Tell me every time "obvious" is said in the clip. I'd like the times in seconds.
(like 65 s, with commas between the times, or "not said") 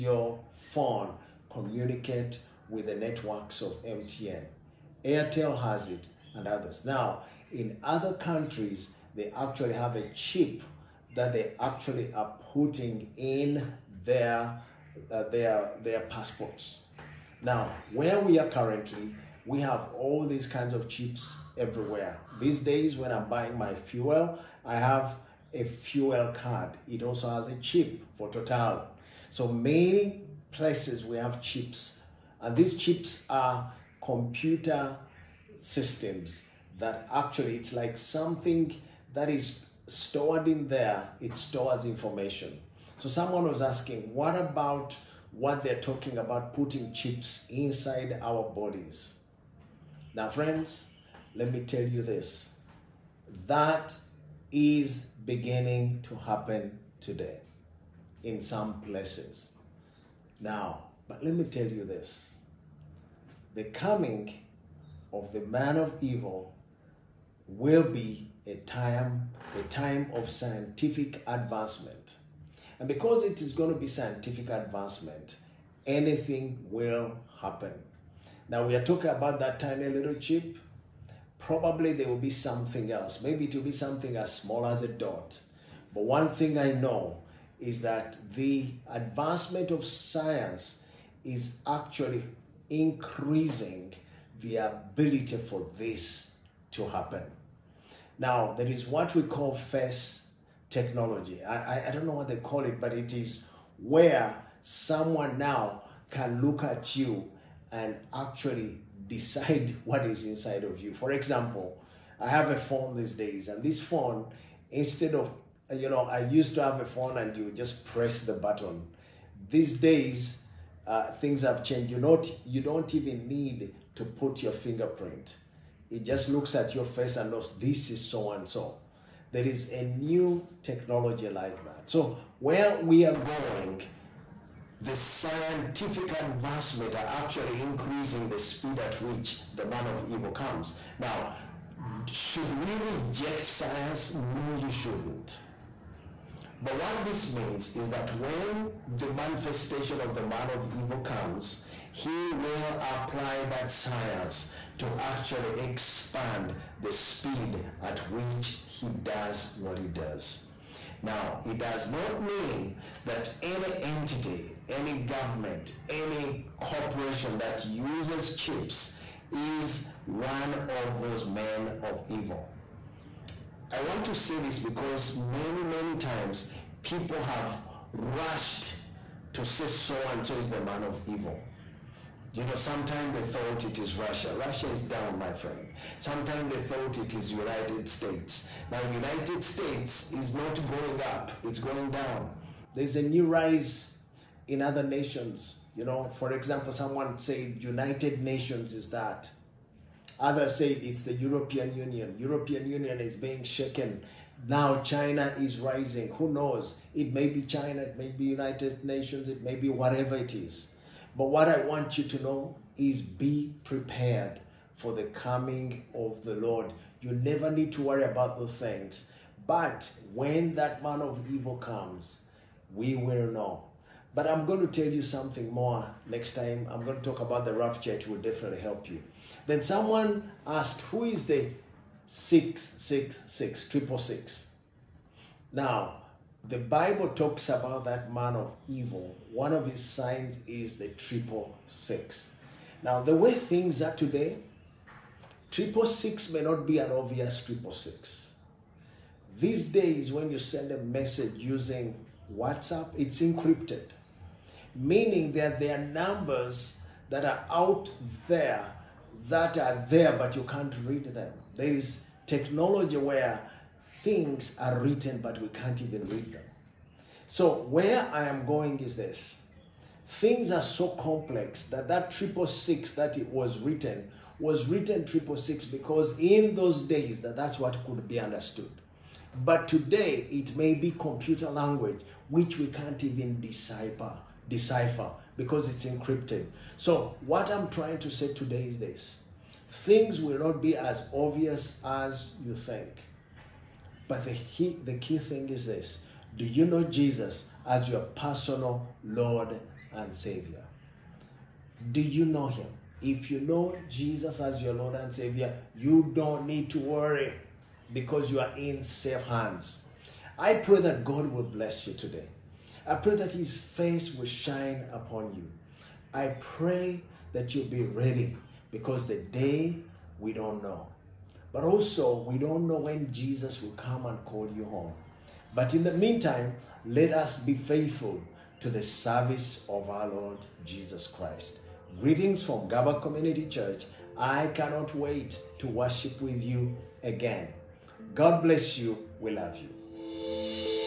246 s, 291 s.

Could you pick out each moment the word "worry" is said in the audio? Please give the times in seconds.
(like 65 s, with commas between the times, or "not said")
217 s, 306 s.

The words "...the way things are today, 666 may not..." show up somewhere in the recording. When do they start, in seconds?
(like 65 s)
243 s.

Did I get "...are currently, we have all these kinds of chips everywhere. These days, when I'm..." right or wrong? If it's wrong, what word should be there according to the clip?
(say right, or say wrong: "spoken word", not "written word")
right.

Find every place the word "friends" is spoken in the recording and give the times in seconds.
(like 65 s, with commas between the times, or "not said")
50 s, 185 s.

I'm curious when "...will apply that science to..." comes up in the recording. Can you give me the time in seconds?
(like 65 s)
152 s.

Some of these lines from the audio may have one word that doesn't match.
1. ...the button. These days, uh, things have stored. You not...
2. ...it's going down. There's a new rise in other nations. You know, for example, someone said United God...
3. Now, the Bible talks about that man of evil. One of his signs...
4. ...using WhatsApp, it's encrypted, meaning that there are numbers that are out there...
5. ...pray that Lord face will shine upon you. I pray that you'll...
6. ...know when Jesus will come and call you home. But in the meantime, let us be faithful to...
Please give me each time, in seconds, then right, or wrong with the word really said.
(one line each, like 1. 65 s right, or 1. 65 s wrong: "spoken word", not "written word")
1. 118 s wrong: "changed", not "stored"
2. 191 s wrong: "Nations", not "God"
3. 235 s right
4. 251 s right
5. 312 s wrong: "His", not "Lord"
6. 322 s right.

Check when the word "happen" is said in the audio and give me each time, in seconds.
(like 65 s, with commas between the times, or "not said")
56 s, 77 s, 96 s.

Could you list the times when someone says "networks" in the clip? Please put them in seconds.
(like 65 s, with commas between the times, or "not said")
2 s.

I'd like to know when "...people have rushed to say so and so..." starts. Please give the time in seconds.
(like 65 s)
176 s.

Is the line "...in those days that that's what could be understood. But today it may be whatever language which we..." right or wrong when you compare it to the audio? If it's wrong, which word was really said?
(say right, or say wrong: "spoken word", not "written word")
wrong: "computer", not "whatever".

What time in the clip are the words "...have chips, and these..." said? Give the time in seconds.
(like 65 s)
31 s.